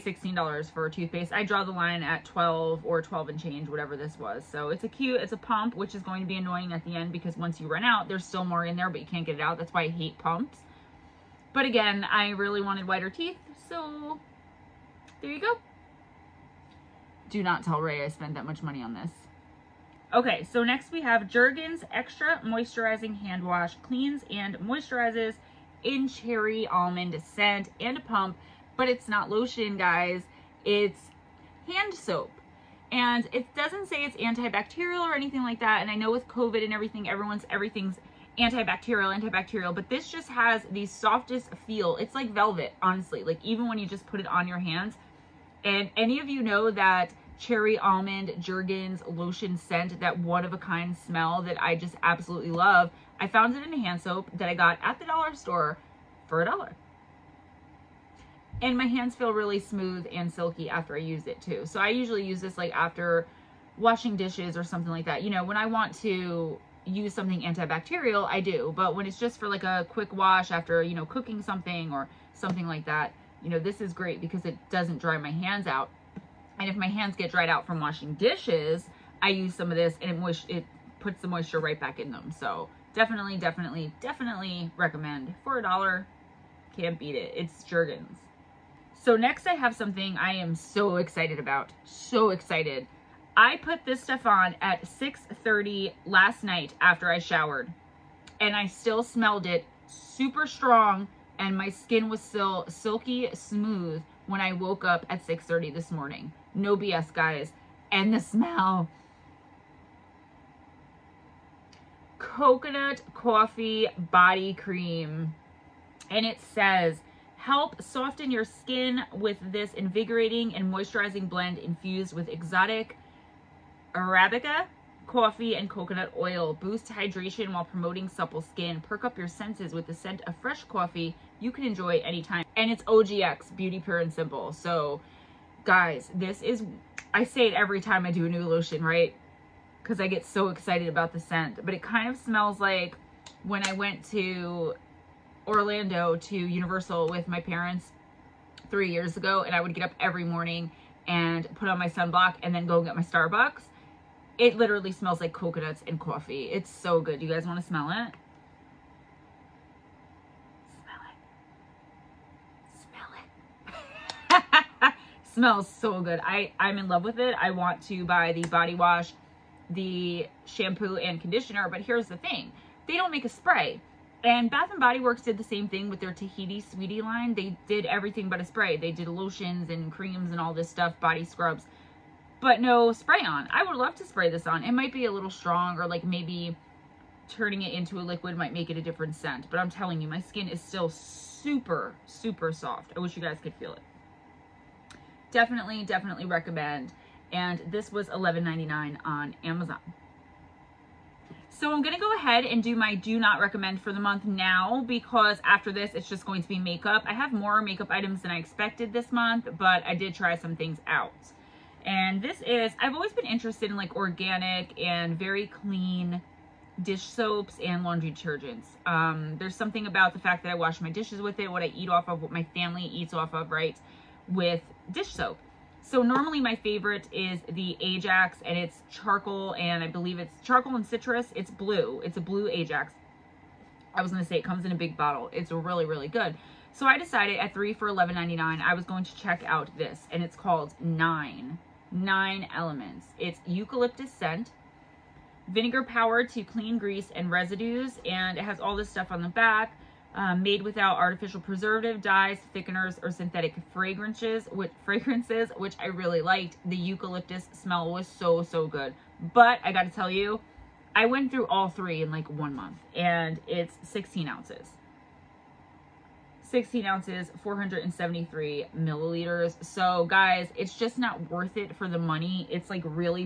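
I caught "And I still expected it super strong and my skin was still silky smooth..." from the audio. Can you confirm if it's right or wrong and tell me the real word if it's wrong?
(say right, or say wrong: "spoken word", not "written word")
wrong: "smelled", not "expected".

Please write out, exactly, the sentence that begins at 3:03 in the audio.
I would love to spray this on.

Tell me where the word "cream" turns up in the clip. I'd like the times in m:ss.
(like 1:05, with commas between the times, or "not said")
1:54, 2:59.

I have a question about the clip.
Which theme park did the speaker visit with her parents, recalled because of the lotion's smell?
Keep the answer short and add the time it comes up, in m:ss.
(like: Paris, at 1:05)
Universal, at 2:26.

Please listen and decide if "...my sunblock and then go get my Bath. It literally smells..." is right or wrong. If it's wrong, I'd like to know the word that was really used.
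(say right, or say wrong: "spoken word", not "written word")
wrong: "Starbucks", not "Bath".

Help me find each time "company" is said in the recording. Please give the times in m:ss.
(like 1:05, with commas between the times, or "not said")
not said.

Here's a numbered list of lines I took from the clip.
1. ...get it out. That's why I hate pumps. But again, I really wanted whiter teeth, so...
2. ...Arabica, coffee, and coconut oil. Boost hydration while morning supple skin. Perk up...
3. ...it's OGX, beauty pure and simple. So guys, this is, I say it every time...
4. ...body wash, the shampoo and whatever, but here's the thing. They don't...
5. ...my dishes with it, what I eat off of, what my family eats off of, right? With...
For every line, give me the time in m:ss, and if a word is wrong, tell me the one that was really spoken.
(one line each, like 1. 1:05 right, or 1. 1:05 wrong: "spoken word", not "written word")
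1. 0:09 right
2. 2:03 wrong: "promoting", not "morning"
3. 2:12 right
4. 2:48 wrong: "conditioner", not "whatever"
5. 3:40 right.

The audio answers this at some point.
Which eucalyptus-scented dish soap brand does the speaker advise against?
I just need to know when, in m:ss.
4:01.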